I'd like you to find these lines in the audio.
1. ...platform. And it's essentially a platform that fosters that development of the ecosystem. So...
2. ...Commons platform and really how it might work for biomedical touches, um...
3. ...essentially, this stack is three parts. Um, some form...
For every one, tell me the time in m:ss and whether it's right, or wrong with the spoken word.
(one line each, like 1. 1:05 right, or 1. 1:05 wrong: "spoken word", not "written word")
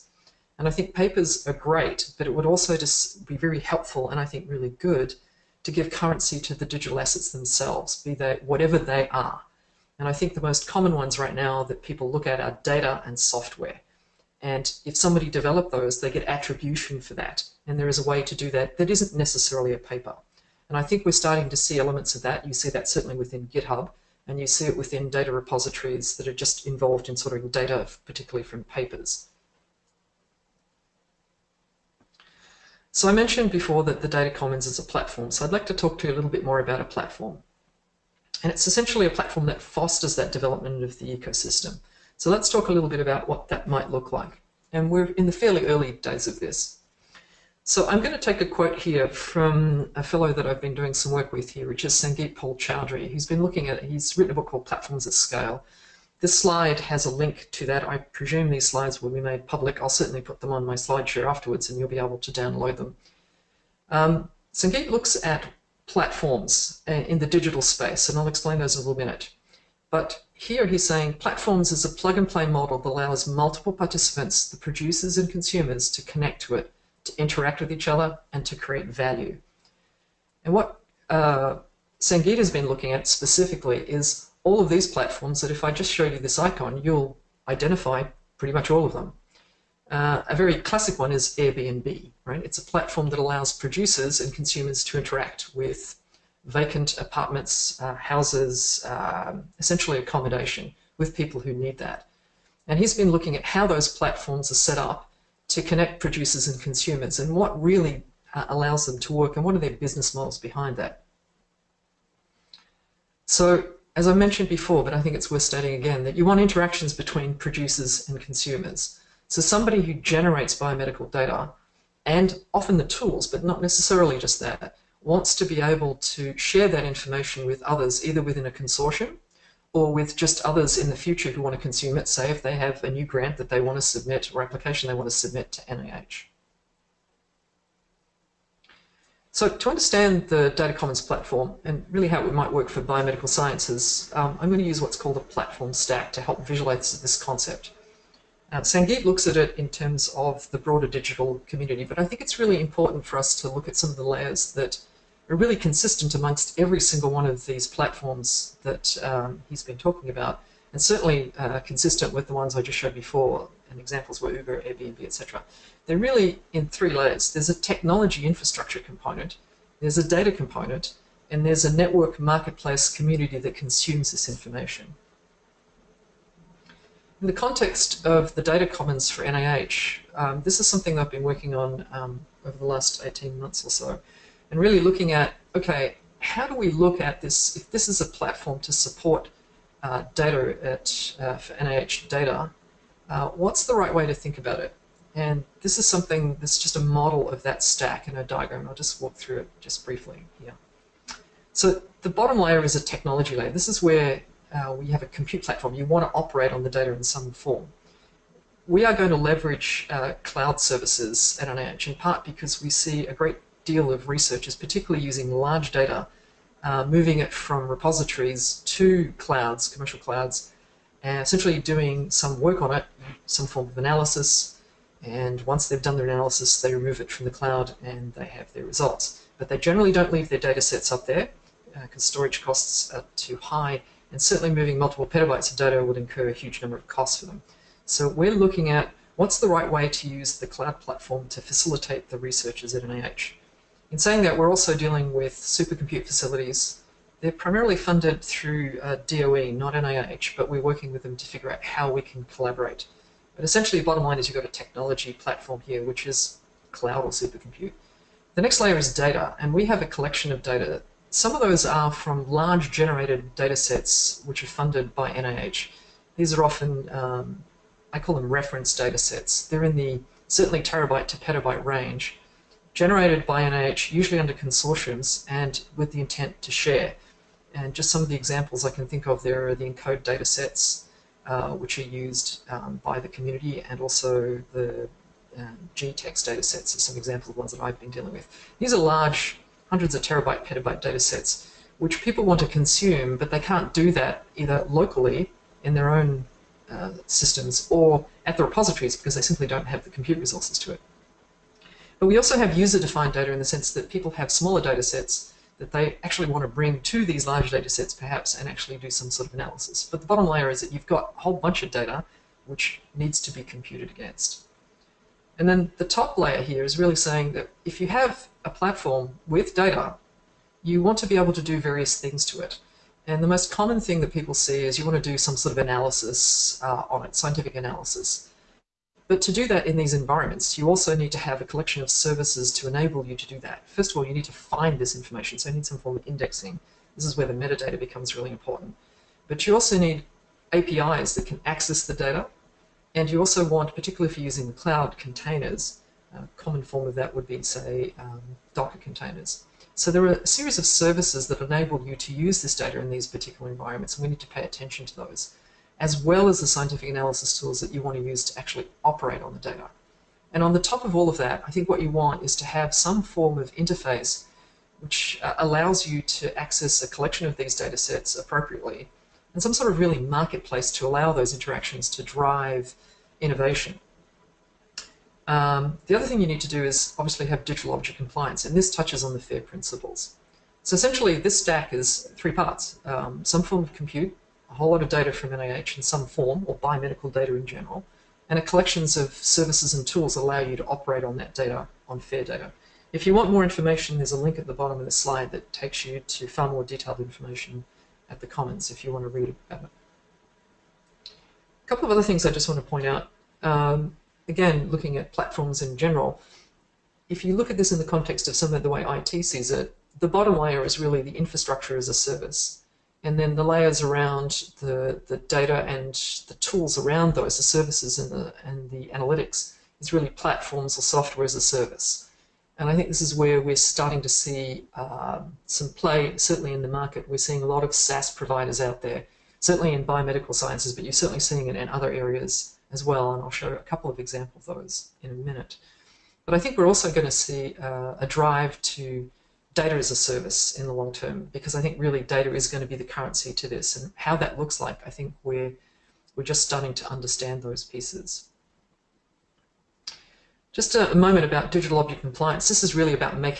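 1. 0:36 right
2. 2:20 wrong: "sciences", not "touches"
3. 6:20 right.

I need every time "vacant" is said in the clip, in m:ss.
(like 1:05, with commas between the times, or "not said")
1:36.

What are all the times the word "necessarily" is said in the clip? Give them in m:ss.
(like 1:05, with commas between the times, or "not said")
0:19, 2:03.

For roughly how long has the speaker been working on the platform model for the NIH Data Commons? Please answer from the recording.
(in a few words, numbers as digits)
18 months.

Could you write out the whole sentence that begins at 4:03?
In saying that, we're also dealing with supercompute facilities.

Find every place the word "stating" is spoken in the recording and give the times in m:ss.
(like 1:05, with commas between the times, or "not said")
1:55.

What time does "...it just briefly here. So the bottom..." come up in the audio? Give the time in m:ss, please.
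3:19.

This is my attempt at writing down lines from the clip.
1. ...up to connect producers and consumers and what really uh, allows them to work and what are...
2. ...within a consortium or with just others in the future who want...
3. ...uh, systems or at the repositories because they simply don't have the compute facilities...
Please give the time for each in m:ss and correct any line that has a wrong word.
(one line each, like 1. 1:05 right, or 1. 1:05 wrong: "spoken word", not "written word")
1. 1:44 right
2. 2:08 right
3. 4:56 wrong: "resources", not "facilities".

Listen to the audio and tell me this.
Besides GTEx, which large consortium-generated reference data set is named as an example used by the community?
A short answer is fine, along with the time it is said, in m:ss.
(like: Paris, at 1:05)
ENCODE, at 4:39.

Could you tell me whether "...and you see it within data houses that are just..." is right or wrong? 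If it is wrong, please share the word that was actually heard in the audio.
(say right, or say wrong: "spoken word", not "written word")
wrong: "repositories", not "houses".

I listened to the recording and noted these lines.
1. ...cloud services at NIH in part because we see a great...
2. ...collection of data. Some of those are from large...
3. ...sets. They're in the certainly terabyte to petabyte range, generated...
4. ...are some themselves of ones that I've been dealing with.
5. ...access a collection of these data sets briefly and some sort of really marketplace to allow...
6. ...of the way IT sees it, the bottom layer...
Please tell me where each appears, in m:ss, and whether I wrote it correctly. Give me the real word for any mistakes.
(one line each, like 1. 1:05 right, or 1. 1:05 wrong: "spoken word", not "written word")
1. 3:30 right
2. 4:19 right
3. 4:28 right
4. 4:46 wrong: "examples", not "themselves"
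5. 6:06 wrong: "appropriately", not "briefly"
6. 6:48 right.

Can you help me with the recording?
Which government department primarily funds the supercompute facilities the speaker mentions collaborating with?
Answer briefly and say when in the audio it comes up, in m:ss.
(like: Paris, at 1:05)
DOE, at 4:09.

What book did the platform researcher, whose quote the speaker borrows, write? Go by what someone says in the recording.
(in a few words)
Platforms at Scale.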